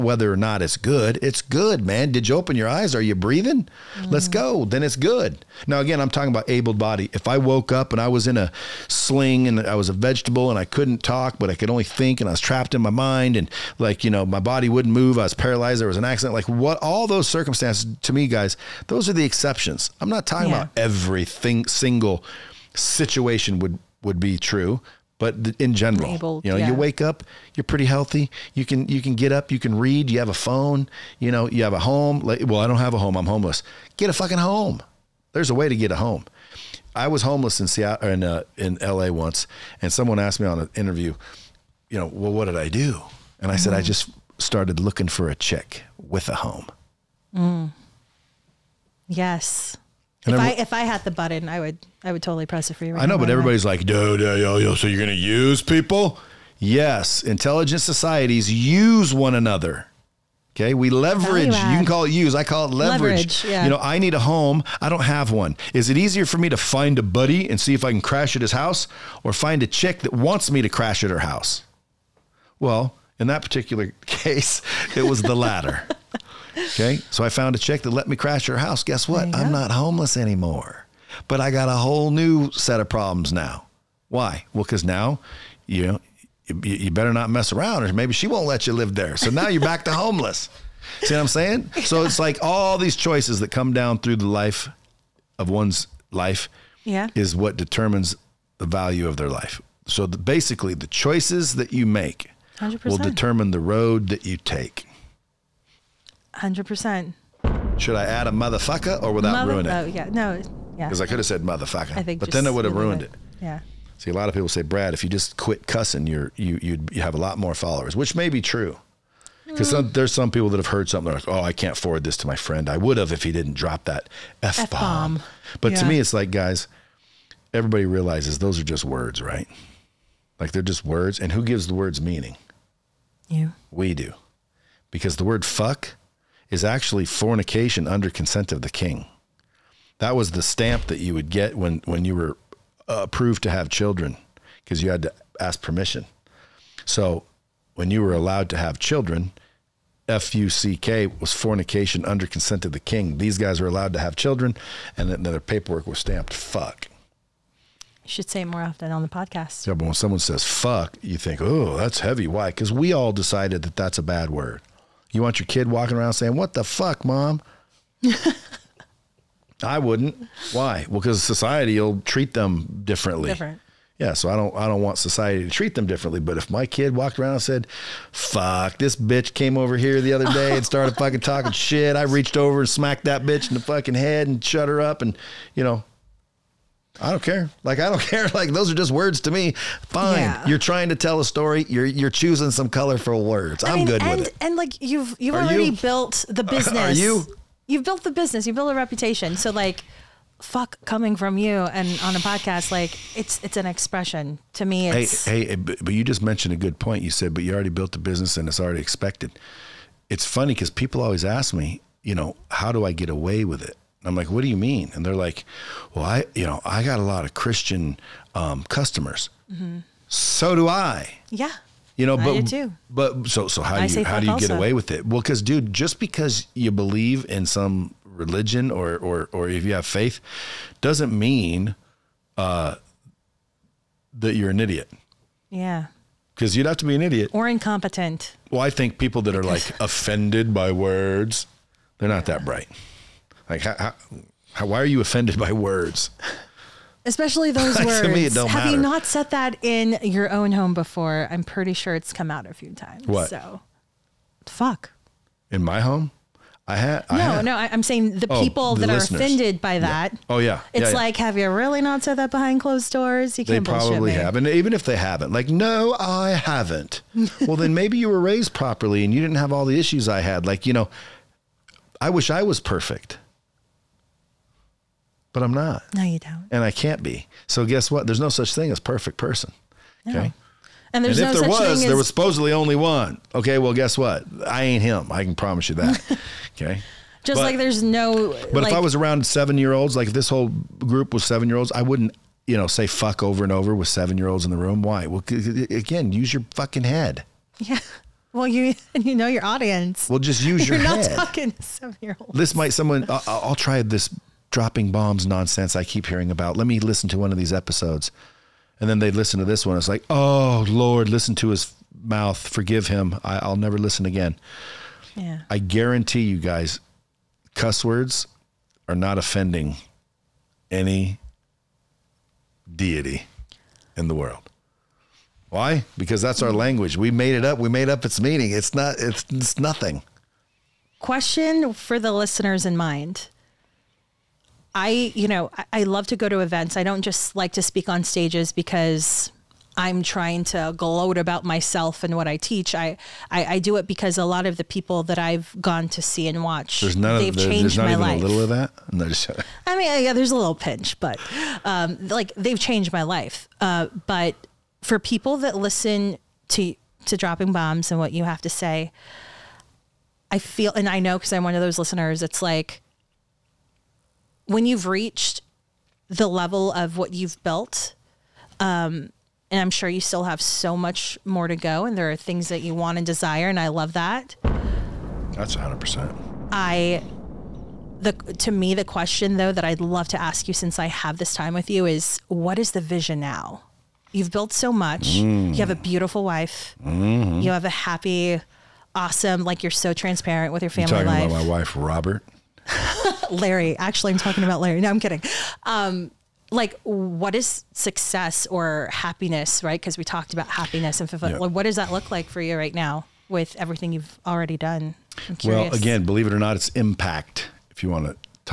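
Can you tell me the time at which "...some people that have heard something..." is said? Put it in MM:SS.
02:00.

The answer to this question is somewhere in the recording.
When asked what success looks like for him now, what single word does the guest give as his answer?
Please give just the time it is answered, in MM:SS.
06:46.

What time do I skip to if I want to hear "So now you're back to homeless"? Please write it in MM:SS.
01:29.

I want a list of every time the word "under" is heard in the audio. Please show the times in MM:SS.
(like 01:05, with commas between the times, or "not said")
02:17, 02:32.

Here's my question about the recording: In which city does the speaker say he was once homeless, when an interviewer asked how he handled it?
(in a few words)
L.A.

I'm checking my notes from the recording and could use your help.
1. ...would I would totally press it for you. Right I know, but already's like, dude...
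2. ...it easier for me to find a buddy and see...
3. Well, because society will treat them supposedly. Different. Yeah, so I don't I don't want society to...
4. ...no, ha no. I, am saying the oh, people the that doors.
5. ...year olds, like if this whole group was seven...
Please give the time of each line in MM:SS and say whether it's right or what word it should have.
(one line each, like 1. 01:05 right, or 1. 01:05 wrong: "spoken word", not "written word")
1. 00:51 wrong: "everybody", not "already"
2. 01:05 right
3. 02:50 wrong: "differently", not "supposedly"
4. 04:17 wrong: "listeners", not "doors"
5. 04:49 right.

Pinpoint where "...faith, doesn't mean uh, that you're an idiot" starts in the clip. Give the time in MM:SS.
03:49.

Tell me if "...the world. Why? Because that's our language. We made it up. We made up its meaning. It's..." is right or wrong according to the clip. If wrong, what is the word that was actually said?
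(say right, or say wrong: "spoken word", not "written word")
right.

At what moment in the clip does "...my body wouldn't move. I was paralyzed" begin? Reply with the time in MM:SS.
00:14.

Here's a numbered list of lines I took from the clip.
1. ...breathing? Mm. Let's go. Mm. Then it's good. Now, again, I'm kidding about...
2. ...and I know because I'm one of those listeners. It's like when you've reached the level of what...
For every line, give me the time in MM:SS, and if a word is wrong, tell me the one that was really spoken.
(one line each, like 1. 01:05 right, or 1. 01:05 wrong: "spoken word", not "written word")
1. 00:03 wrong: "talking", not "kidding"
2. 06:00 right.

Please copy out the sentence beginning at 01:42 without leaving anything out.
will determine the road that you take.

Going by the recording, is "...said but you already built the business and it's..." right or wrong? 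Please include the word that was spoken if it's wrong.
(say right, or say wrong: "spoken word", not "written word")
right.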